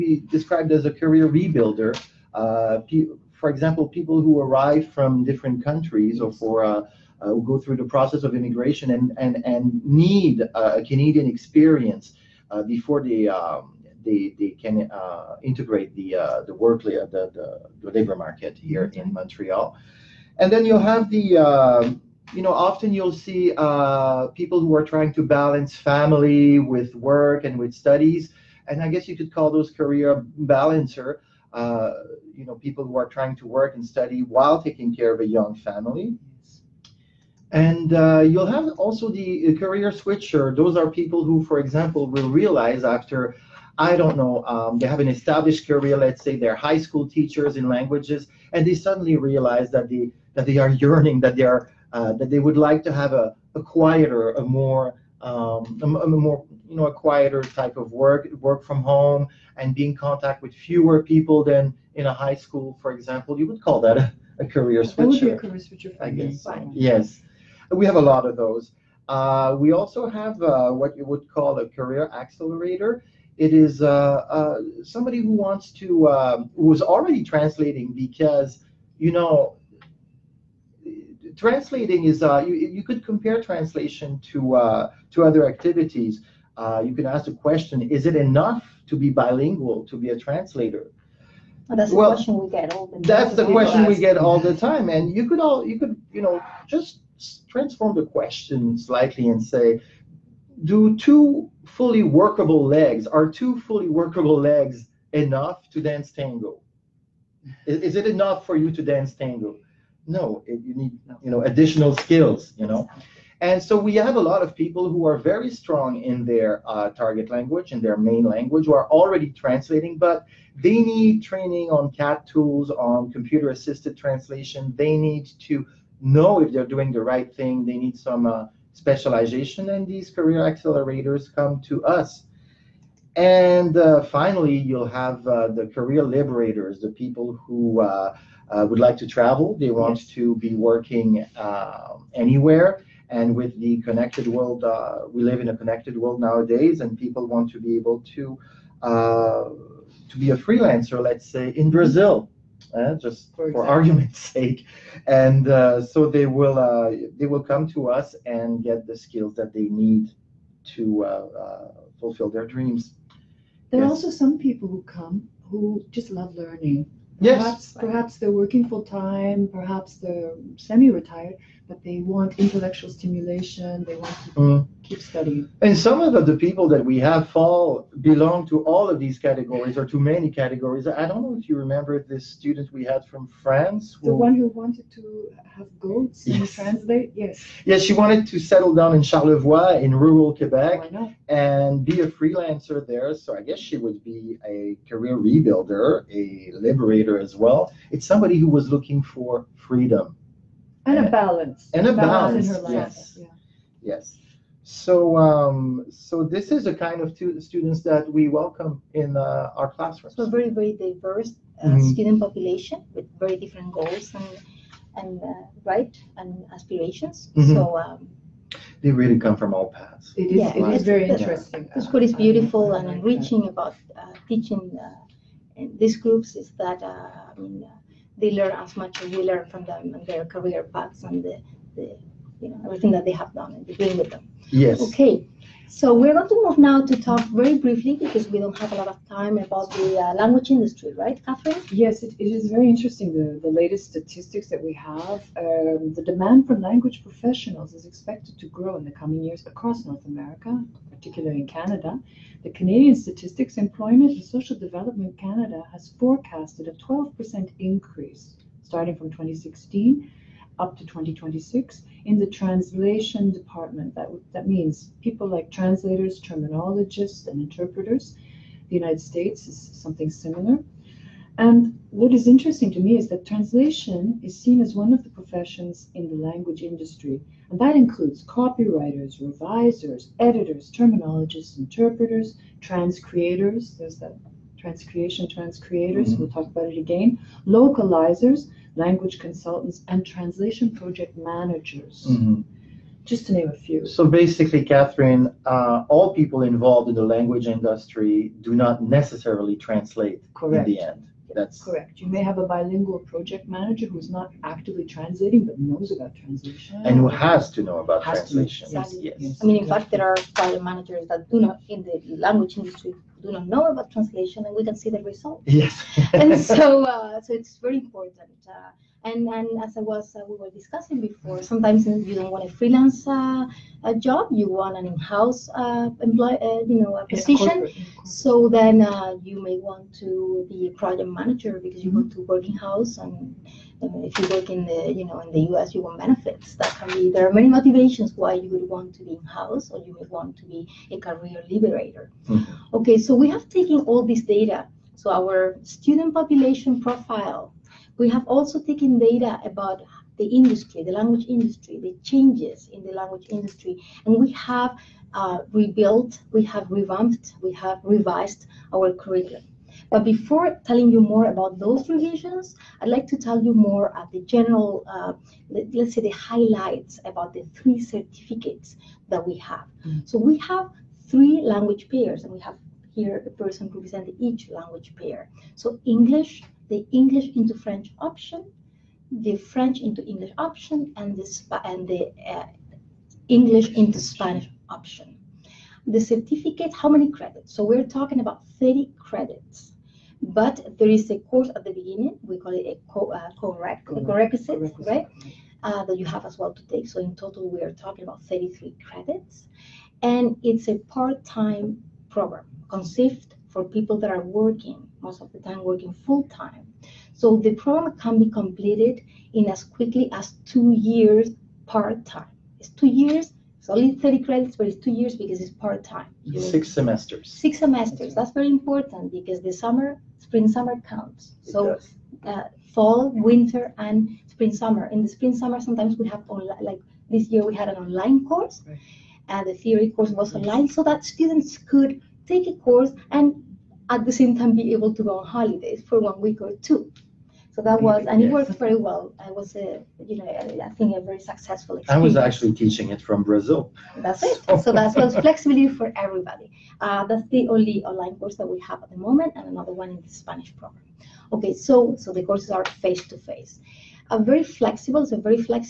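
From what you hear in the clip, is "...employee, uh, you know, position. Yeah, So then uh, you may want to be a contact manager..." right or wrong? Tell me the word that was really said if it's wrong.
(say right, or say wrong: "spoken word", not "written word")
wrong: "project", not "contact".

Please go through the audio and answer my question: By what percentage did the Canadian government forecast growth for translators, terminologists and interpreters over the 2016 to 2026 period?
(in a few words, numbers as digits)
12%.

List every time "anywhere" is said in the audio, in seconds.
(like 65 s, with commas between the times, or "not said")
142 s.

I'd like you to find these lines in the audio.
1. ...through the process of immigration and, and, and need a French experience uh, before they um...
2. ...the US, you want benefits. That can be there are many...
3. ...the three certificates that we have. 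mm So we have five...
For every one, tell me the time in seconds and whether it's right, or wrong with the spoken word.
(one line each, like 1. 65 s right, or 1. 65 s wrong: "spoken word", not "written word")
1. 7 s wrong: "Canadian", not "French"
2. 335 s right
3. 367 s wrong: "three", not "five".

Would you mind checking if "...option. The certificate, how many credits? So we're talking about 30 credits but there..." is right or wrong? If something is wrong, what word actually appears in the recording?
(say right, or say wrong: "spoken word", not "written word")
right.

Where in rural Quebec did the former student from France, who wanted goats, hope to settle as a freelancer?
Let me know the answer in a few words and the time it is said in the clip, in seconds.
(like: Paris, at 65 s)
Charlevoix, at 189 s.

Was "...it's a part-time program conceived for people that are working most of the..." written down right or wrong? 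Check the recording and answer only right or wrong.
right.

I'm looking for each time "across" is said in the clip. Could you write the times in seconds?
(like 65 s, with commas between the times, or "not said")
249 s.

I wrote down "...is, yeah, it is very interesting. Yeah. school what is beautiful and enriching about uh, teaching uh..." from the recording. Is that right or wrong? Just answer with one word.
right.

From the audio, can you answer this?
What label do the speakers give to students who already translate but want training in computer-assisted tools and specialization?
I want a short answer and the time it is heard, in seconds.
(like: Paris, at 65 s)
career accelerator, at 71 s.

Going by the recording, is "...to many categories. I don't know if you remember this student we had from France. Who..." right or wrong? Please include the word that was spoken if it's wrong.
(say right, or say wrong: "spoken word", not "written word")
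right.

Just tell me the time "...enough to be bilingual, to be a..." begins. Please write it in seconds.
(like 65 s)
88 s.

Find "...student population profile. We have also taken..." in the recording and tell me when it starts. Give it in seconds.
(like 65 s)
345 s.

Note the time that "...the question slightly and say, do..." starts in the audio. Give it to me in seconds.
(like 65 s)
97 s.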